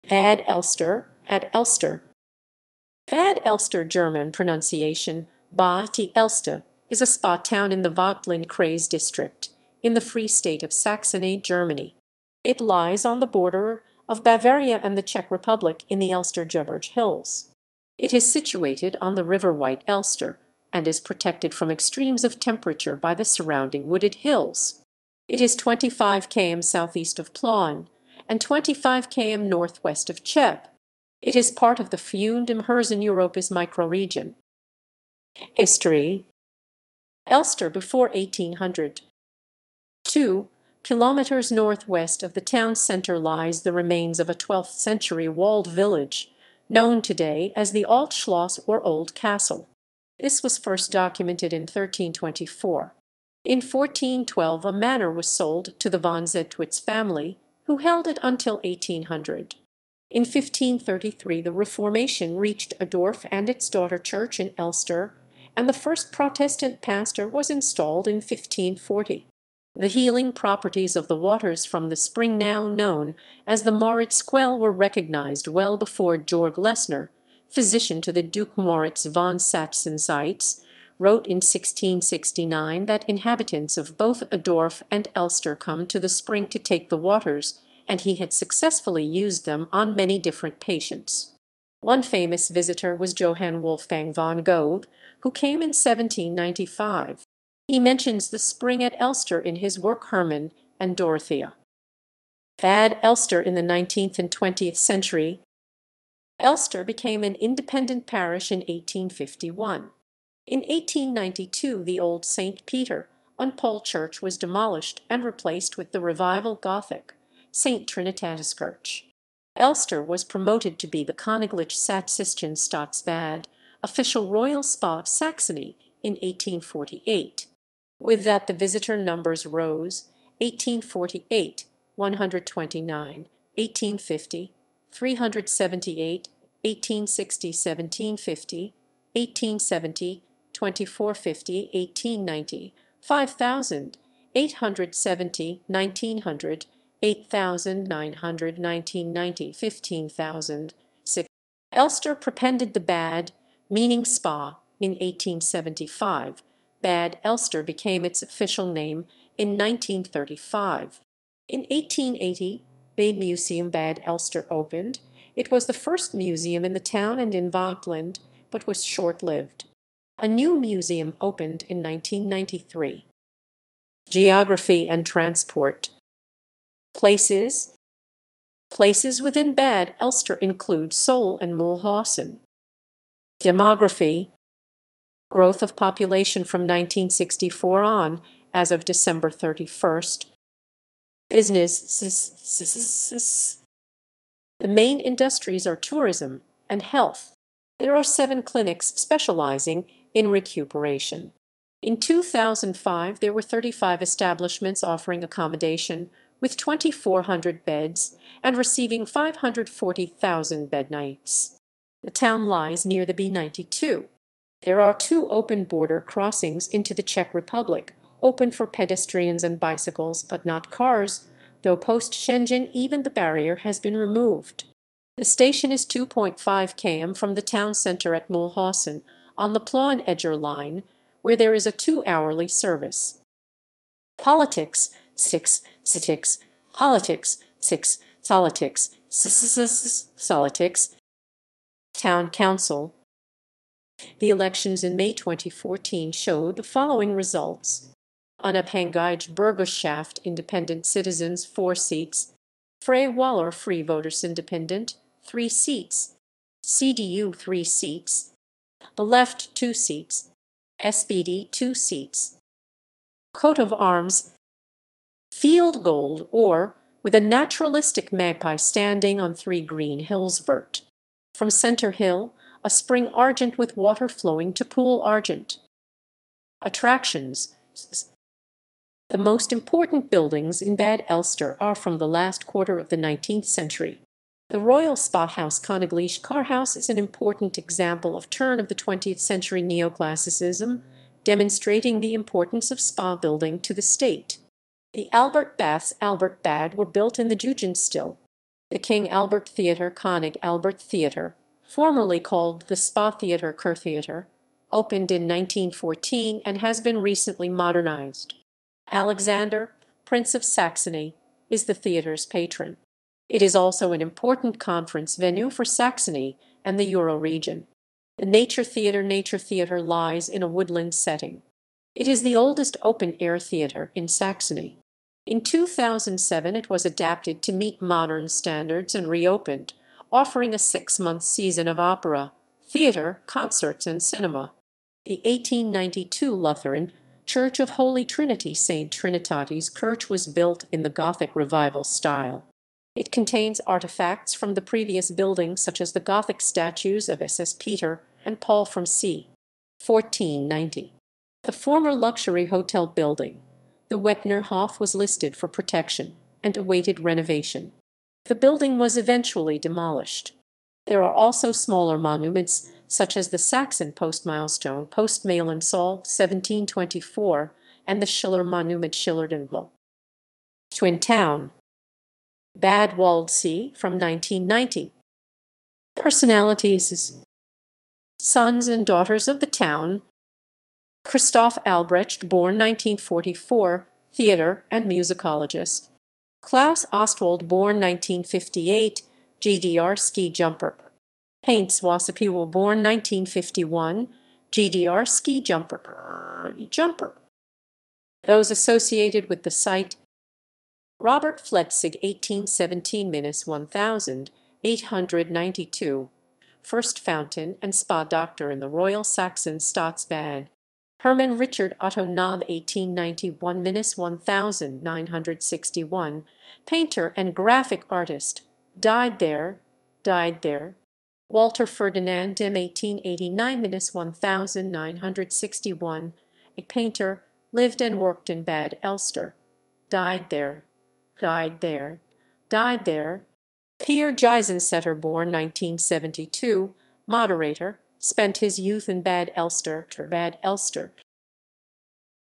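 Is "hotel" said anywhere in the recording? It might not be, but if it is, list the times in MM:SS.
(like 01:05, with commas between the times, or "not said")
05:52.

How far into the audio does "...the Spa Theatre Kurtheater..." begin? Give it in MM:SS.
05:02.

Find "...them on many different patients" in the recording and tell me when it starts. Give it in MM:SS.
01:29.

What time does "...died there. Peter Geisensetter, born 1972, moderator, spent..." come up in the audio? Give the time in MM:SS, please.
07:12.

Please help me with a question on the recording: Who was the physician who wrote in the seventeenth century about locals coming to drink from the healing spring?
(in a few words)
Georg Lesner.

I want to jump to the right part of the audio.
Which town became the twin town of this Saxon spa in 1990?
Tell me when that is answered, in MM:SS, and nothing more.
06:12.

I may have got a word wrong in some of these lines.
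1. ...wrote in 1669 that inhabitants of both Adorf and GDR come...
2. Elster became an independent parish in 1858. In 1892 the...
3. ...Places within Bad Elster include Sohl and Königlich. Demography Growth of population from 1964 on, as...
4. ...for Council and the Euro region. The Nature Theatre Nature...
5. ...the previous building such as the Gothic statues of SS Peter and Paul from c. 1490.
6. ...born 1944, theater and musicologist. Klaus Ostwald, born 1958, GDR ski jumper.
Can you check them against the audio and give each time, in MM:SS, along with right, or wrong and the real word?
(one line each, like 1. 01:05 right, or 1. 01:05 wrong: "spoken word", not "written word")
1. 01:21 wrong: "Elster", not "GDR"
2. 01:46 wrong: "1851", not "1858"
3. 02:58 wrong: "Mühlhausen", not "Königlich"
4. 05:15 wrong: "Saxony", not "Council"
5. 05:44 right
6. 06:22 right.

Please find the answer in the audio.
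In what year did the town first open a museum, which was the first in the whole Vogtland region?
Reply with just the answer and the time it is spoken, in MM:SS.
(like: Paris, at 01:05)
1880, at 02:41.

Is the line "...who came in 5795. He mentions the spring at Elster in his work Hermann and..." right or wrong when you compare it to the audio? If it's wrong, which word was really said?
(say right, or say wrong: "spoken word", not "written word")
wrong: "1795", not "5795".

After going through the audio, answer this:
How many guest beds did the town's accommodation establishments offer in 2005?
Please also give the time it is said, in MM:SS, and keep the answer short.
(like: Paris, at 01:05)
2,400, at 03:26.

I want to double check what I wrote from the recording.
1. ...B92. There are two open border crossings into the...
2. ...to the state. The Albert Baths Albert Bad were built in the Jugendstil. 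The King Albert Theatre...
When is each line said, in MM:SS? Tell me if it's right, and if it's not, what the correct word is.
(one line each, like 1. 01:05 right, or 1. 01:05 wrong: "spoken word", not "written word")
1. 03:33 right
2. 04:53 right.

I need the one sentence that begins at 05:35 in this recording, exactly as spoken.
The 1892 Lutheran Church of Holy Trinity St.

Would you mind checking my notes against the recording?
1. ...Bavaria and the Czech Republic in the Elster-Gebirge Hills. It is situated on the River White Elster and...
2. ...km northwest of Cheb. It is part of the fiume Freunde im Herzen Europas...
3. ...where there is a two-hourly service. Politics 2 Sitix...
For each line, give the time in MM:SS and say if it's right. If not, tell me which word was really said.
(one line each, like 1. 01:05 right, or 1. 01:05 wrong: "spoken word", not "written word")
1. 00:14 right
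2. 00:29 right
3. 03:51 wrong: "6", not "2".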